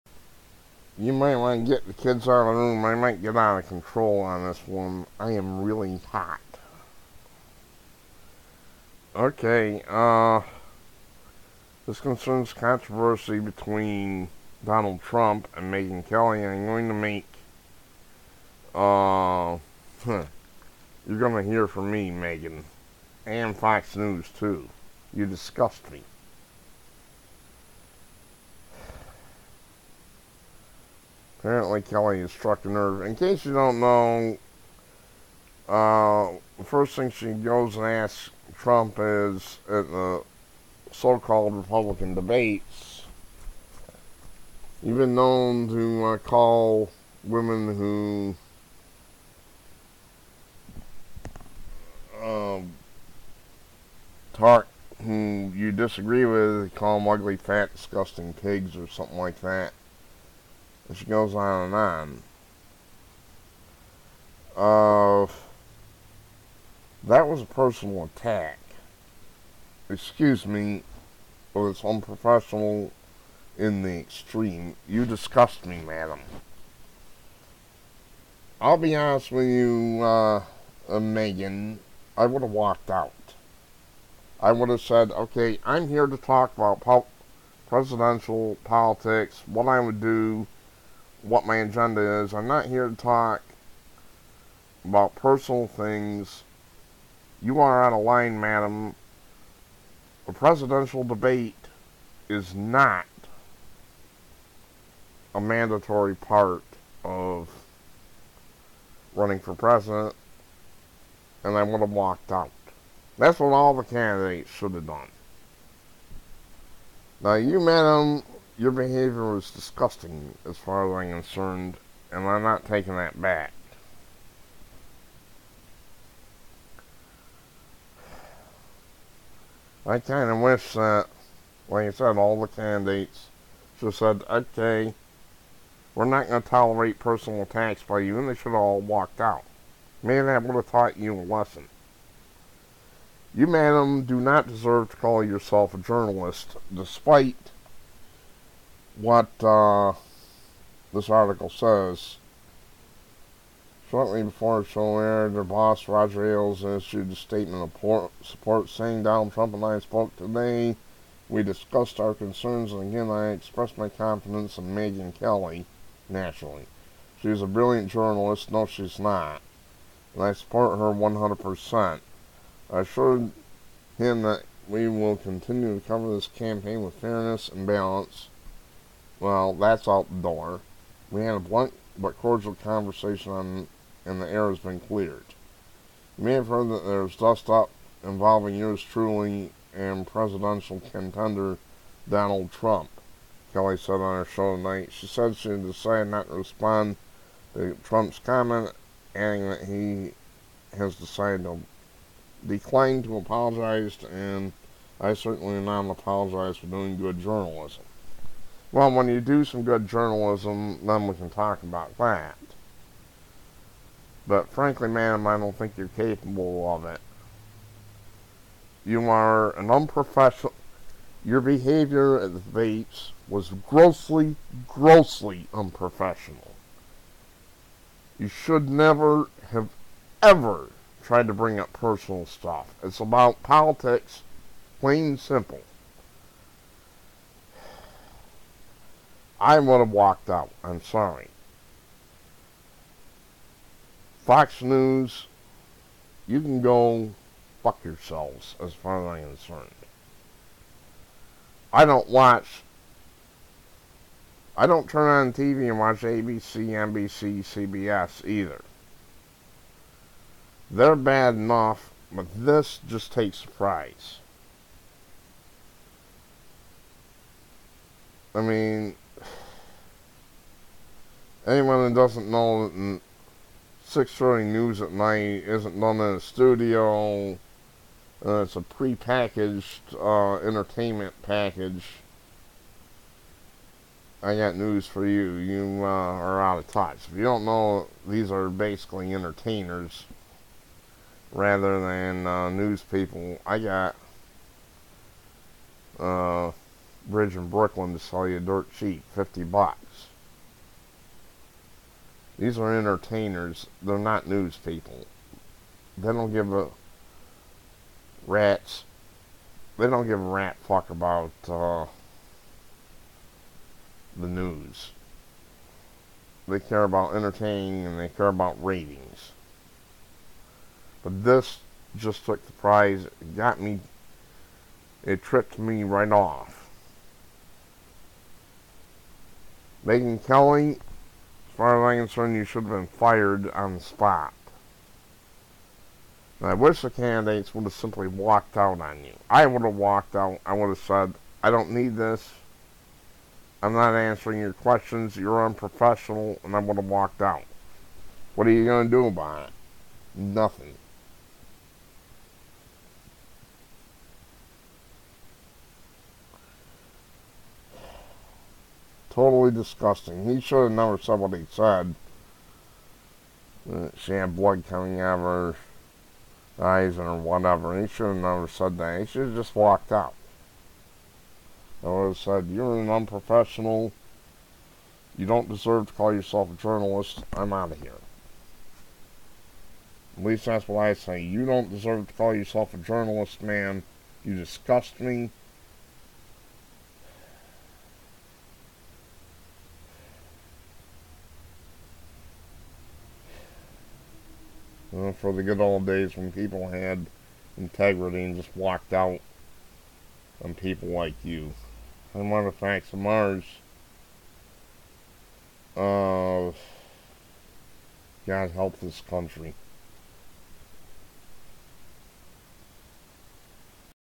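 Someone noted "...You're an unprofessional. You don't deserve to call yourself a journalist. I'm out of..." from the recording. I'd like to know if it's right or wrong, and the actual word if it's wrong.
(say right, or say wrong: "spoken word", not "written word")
right.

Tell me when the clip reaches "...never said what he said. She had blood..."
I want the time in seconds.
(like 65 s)
360 s.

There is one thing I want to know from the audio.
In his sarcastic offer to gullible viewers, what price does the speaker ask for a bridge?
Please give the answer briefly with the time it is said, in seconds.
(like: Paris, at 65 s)
50 bucks, at 299 s.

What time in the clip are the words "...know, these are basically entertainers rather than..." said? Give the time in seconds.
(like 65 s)
287 s.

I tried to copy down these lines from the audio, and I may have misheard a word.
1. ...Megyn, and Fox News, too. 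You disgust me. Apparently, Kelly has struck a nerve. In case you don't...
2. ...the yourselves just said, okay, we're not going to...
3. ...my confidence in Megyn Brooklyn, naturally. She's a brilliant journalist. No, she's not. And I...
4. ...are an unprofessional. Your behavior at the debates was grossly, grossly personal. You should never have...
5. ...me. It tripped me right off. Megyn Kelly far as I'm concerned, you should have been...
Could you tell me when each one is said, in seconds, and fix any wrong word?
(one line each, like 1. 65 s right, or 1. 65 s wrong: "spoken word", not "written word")
1. 22 s right
2. 132 s wrong: "candidates", not "yourselves"
3. 163 s wrong: "Kelly", not "Brooklyn"
4. 219 s wrong: "unprofessional", not "personal"
5. 323 s right.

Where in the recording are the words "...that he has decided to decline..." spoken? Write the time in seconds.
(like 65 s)
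199 s.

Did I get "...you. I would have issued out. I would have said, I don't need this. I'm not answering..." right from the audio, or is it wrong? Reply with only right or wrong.
wrong.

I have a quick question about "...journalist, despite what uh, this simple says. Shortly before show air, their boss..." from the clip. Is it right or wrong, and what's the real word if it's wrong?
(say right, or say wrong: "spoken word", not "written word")
wrong: "article", not "simple".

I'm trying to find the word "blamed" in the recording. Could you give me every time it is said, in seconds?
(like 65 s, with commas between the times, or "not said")
not said.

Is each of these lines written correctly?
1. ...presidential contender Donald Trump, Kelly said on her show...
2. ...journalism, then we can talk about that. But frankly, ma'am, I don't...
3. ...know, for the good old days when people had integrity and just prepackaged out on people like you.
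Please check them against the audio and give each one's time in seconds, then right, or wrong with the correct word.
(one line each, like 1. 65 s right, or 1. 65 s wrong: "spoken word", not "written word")
1. 190 s right
2. 209 s right
3. 394 s wrong: "walked", not "prepackaged".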